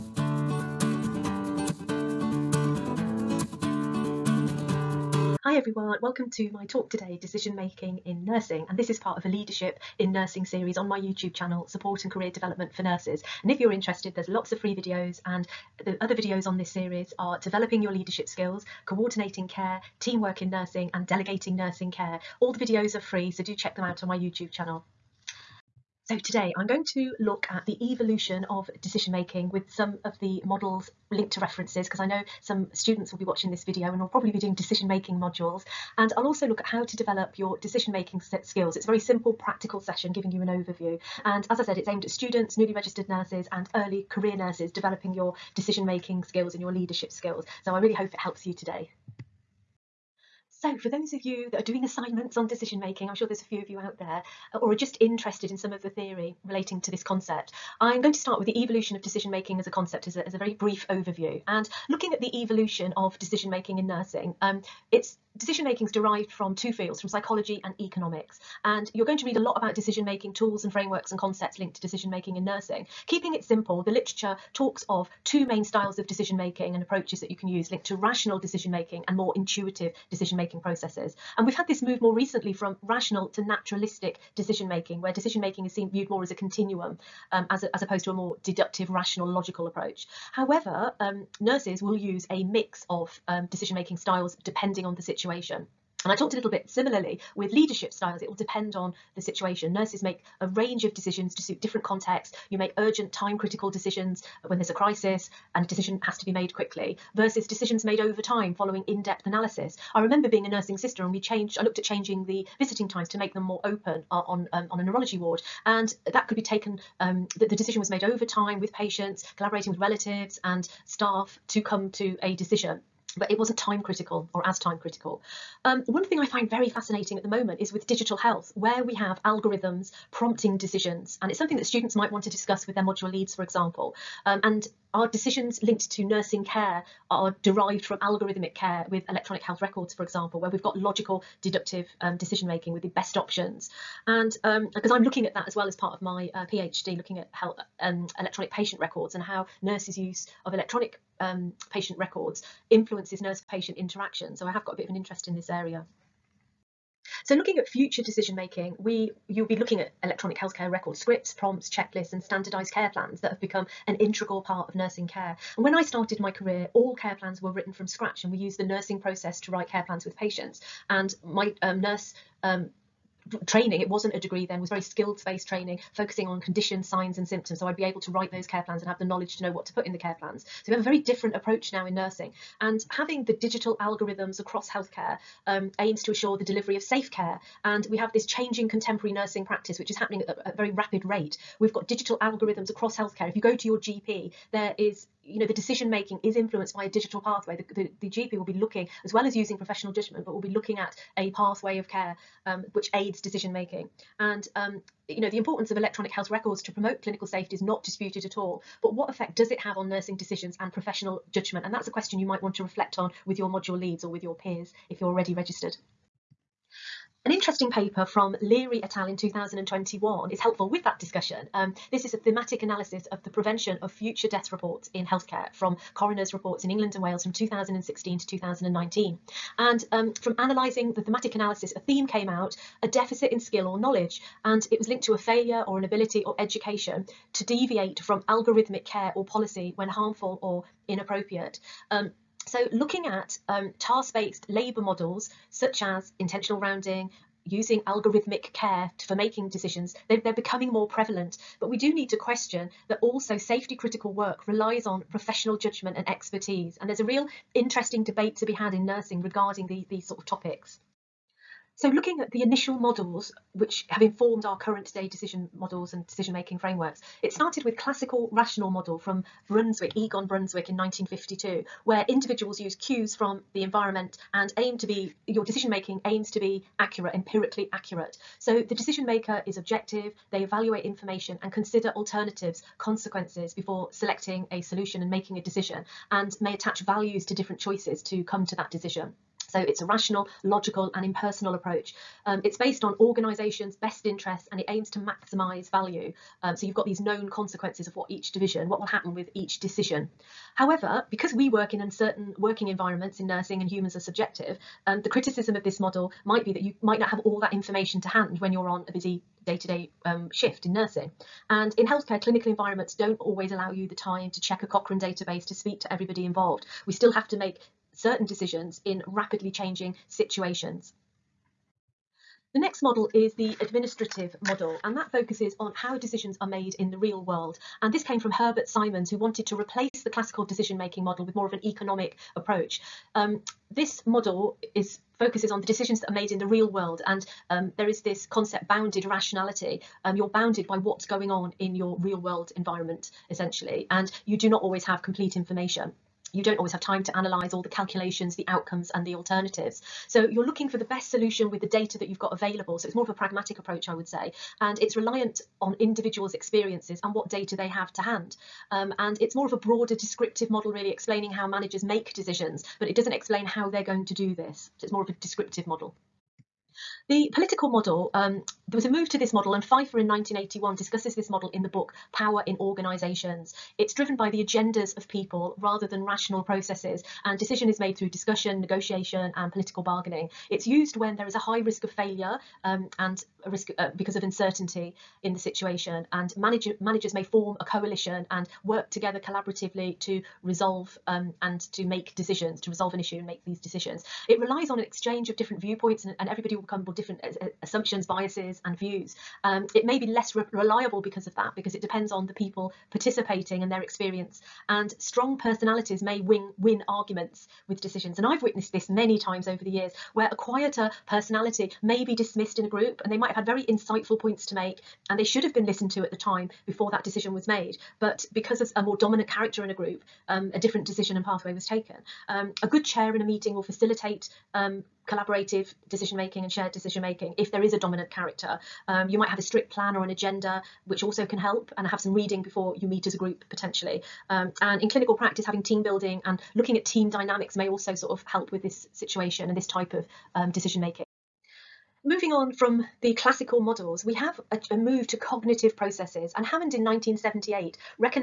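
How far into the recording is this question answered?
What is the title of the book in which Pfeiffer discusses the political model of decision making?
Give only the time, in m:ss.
6:12.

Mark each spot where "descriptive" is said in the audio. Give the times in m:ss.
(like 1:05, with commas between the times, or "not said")
5:59, 6:05.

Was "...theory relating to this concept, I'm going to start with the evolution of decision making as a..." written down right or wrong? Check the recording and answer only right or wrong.
right.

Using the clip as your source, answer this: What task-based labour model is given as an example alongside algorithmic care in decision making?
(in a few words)
intentional rounding.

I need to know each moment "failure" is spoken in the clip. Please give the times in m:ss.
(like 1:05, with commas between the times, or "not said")
3:55, 6:21.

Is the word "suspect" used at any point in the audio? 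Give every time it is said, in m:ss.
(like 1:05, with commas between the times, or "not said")
not said.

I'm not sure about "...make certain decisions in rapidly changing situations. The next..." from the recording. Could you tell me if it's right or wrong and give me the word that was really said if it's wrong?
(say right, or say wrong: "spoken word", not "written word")
right.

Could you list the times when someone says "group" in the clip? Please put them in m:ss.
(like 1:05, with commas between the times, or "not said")
6:52, 6:59, 7:13.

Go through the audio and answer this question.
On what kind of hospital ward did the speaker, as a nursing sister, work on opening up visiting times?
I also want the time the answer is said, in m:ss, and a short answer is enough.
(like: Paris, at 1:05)
neurology, at 1:54.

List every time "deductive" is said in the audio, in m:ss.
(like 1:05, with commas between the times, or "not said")
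1:28, 2:21.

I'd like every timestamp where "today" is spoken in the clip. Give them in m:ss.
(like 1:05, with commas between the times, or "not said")
0:06, 0:26, 0:48.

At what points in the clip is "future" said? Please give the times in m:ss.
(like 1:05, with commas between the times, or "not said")
2:37, 3:43.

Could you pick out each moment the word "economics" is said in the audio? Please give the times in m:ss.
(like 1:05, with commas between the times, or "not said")
1:07, 5:31.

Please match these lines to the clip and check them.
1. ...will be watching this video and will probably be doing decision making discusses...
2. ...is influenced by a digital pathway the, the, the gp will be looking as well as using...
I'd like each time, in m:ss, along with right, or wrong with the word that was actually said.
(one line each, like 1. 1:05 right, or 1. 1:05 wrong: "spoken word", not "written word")
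1. 0:33 wrong: "modules", not "discusses"
2. 3:16 right.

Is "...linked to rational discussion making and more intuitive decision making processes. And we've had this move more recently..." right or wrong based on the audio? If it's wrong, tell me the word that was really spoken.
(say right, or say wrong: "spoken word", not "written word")
wrong: "decision", not "discussion".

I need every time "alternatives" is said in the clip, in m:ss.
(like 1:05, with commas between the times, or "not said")
4:41, 5:49.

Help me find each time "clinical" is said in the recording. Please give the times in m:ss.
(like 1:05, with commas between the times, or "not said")
3:27, 5:12, 7:14.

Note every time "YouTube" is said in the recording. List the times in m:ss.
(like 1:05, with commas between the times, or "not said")
0:10, 0:24.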